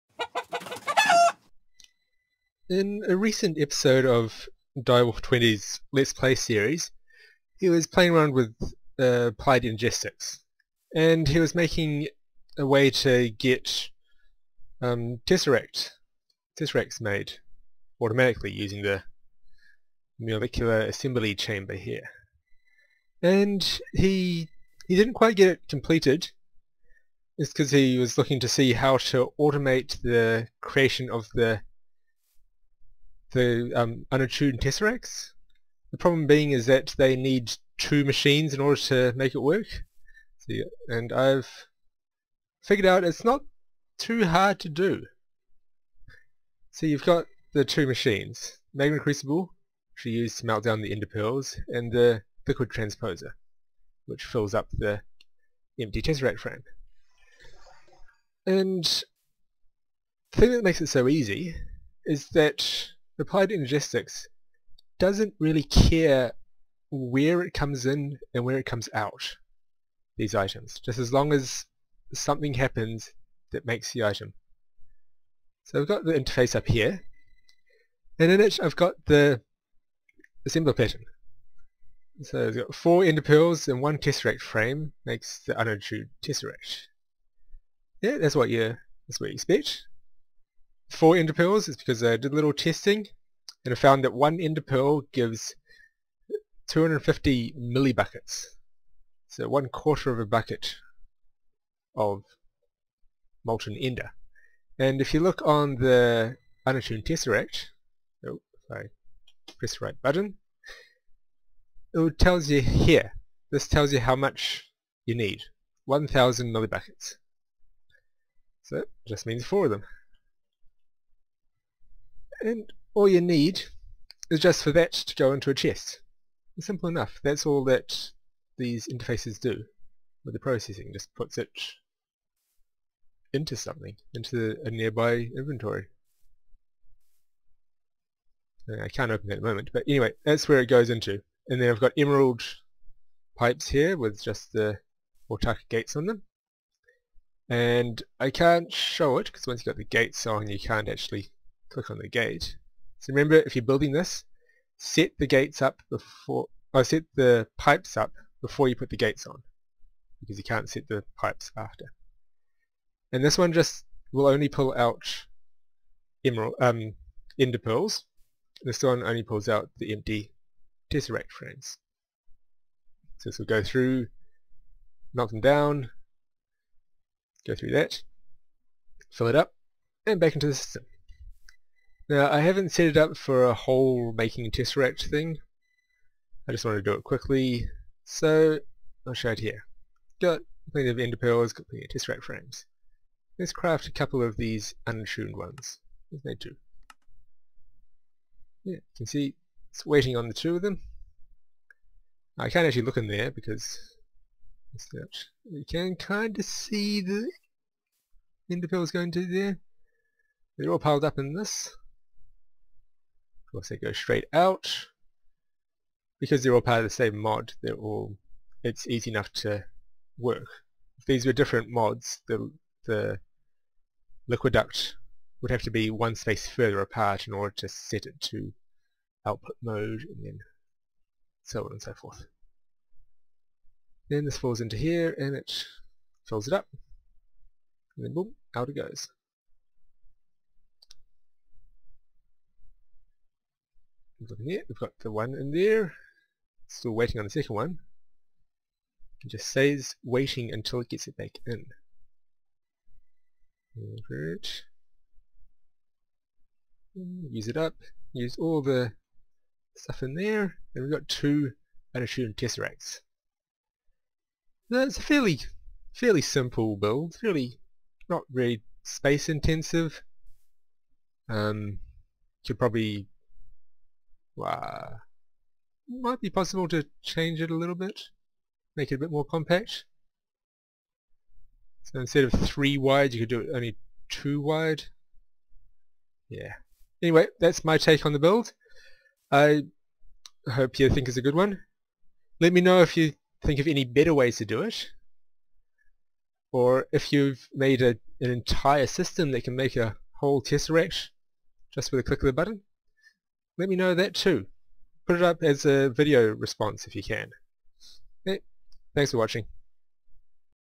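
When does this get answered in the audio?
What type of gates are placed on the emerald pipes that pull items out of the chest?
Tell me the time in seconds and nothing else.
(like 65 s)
145 s.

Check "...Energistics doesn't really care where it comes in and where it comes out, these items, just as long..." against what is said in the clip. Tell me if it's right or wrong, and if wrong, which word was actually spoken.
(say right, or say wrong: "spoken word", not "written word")
right.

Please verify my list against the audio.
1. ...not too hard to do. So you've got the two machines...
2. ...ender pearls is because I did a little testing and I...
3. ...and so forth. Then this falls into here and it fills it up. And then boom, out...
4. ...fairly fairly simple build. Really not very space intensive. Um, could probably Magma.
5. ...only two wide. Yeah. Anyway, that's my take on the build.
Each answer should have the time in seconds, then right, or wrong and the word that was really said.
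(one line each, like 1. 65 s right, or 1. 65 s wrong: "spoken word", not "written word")
1. 43 s right
2. 91 s right
3. 231 s right
4. 265 s wrong: "Wow", not "Magma"
5. 283 s right.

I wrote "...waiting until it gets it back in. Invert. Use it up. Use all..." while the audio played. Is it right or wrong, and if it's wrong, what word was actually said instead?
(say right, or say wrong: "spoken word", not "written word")
right.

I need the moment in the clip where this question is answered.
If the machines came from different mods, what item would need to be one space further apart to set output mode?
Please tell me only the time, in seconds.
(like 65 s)
224 s.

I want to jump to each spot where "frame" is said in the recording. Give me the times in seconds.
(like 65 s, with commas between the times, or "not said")
56 s, 84 s, 171 s, 192 s.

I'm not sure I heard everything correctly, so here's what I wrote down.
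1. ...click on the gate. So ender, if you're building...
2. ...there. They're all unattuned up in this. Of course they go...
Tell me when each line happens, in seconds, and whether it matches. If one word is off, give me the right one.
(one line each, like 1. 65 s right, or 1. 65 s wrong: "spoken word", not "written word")
1. 151 s wrong: "remember", not "ender"
2. 209 s wrong: "piled", not "unattuned".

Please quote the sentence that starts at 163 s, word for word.
And this one just will only pull out emerald, um, ender pearls.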